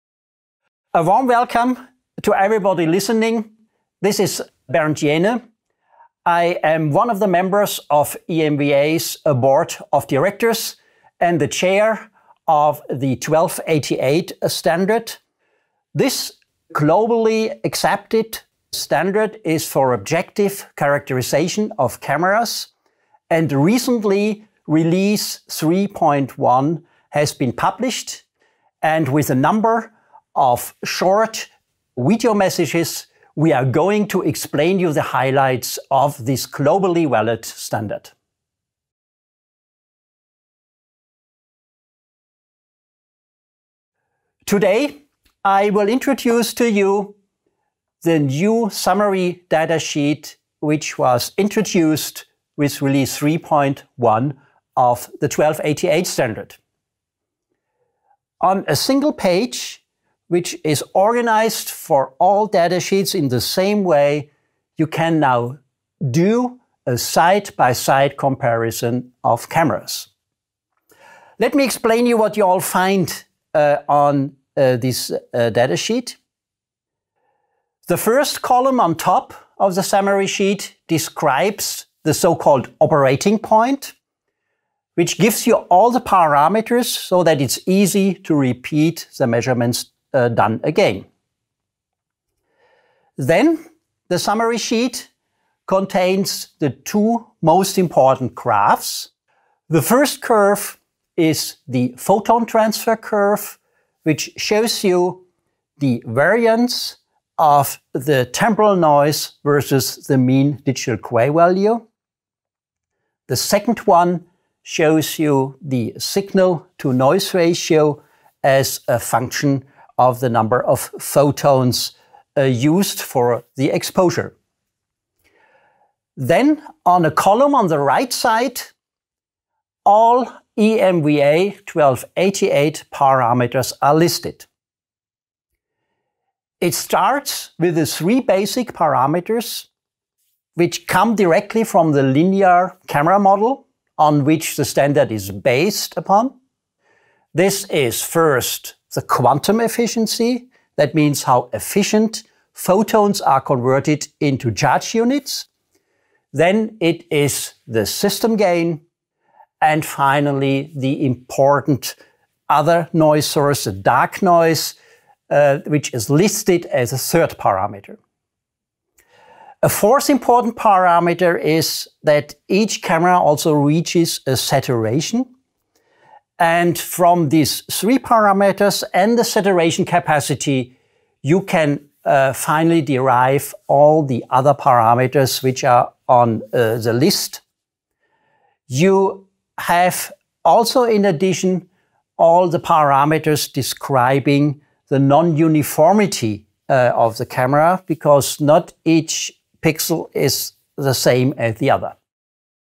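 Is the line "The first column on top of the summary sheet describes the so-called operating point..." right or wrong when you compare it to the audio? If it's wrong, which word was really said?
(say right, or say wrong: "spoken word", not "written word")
right.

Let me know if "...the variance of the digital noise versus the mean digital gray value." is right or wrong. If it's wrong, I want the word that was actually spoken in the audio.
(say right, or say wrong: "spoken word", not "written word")
wrong: "temporal", not "digital".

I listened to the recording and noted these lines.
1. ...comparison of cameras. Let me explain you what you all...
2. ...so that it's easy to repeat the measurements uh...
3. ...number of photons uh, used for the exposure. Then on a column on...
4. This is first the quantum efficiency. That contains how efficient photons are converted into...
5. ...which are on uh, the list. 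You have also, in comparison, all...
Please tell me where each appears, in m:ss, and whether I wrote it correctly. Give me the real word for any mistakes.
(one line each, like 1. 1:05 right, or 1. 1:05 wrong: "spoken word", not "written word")
1. 1:08 right
2. 1:26 right
3. 2:00 right
4. 2:27 wrong: "means", not "contains"
5. 3:05 wrong: "addition", not "comparison".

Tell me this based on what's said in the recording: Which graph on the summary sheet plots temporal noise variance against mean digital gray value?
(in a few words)
photon transfer curve.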